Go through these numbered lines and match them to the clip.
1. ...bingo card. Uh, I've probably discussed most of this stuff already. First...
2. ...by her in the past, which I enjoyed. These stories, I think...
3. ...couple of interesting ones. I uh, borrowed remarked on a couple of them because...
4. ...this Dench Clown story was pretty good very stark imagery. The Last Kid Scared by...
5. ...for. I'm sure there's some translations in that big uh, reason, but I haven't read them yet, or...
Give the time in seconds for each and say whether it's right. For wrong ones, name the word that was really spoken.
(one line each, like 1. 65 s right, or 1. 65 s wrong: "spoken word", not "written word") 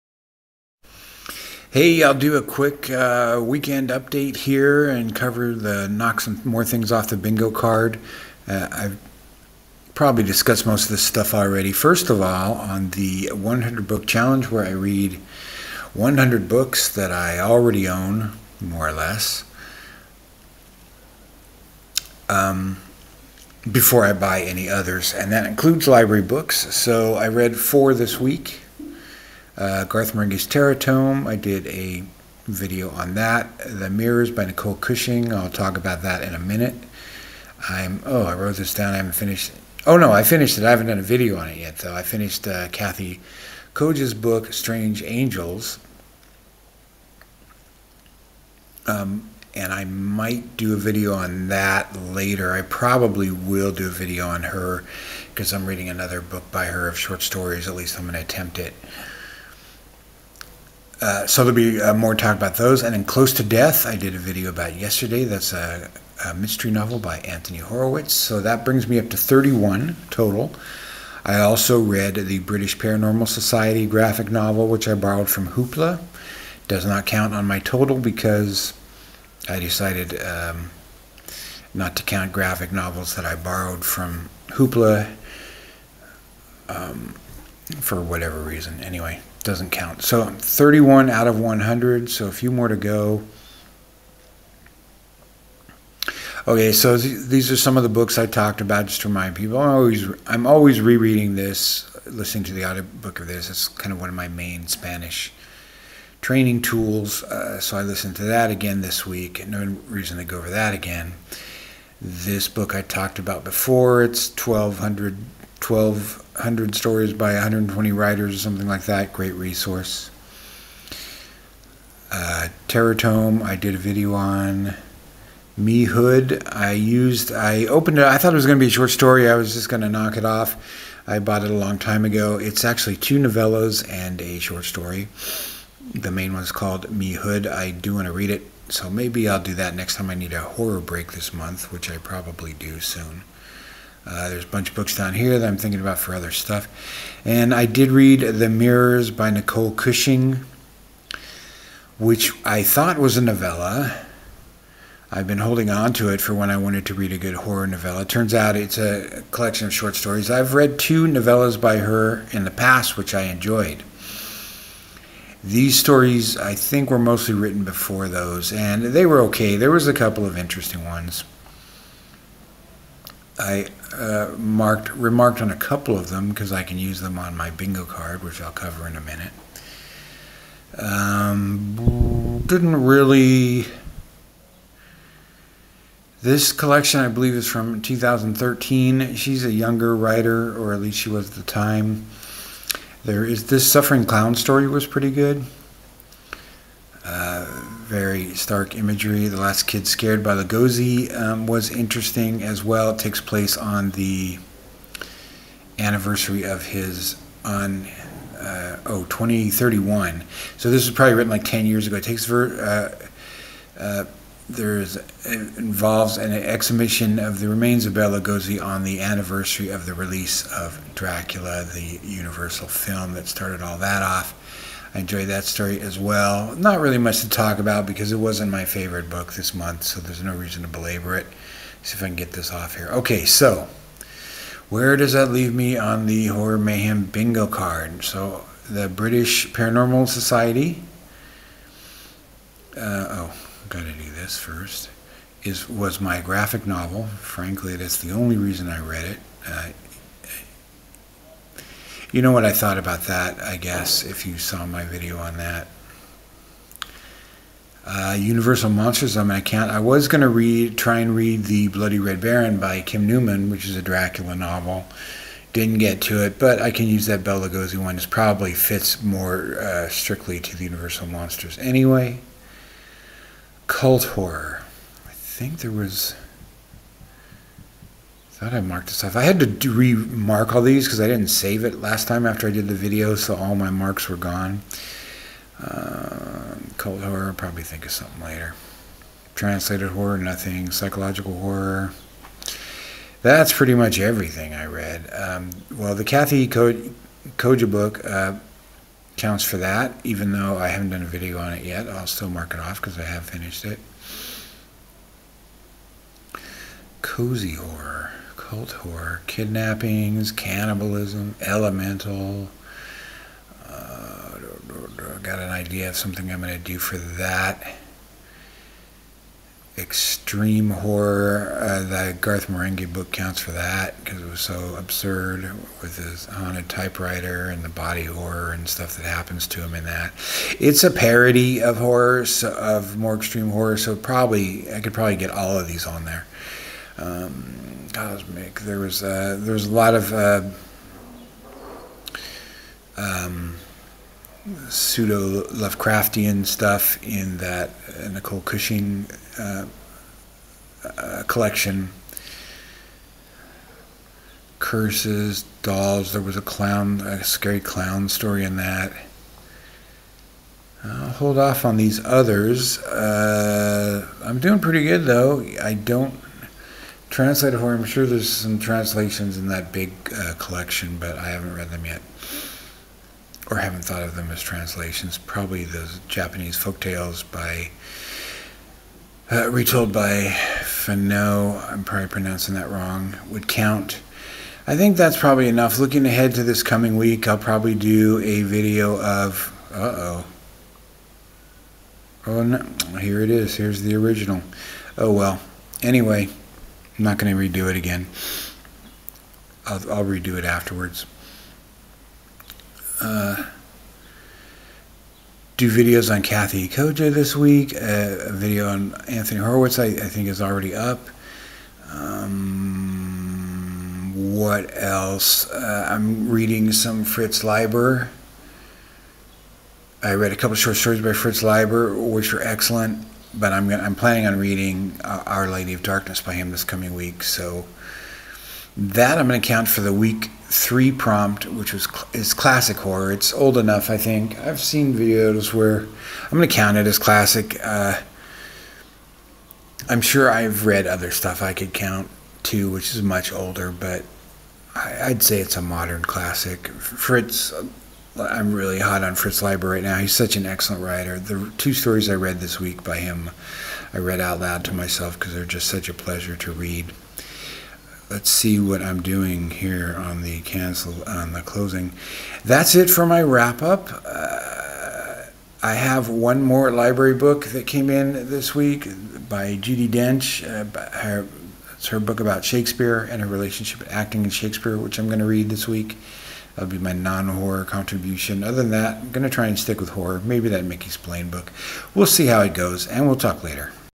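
1. 7 s right
2. 161 s right
3. 169 s wrong: "marked", not "borrowed"
4. 193 s wrong: "Suffering", not "Dench"
5. 367 s wrong: "collection", not "reason".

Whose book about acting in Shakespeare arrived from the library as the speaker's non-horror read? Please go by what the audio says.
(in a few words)
Judi Dench.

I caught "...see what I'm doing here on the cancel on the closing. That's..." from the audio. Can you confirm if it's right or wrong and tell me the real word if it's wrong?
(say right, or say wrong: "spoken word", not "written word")
right.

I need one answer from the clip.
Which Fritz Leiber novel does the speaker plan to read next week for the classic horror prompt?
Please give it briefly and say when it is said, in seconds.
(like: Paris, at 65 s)
Our Lady of Darkness, at 425 s.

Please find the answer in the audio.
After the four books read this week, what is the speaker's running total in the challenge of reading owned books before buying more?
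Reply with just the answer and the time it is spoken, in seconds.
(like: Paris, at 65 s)
31, at 69 s.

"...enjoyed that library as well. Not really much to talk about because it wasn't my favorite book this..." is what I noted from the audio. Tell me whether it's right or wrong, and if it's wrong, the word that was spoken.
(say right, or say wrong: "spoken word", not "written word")
wrong: "story", not "library".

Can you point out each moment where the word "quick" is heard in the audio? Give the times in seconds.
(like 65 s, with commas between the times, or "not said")
2 s.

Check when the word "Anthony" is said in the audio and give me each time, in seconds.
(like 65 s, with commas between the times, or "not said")
67 s, 409 s.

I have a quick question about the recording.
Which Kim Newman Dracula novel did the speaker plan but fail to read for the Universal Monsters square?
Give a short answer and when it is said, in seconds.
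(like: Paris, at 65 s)
The Bloody Red Baron, at 261 s.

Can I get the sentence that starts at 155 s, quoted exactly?
I've been holding on to it for when I wanted to read a good horror novella.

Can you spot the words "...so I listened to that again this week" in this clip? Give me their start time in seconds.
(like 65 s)
107 s.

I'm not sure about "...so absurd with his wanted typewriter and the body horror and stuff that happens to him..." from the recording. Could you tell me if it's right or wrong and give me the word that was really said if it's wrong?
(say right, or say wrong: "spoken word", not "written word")
wrong: "haunted", not "wanted".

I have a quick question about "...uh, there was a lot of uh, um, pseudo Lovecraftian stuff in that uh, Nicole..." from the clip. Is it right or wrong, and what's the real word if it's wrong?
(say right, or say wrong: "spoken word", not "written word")
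right.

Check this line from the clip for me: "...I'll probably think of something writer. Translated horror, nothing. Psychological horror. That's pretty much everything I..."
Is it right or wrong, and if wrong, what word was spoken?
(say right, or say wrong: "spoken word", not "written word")
wrong: "later", not "writer".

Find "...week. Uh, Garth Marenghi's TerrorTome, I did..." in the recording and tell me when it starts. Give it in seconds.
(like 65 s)
28 s.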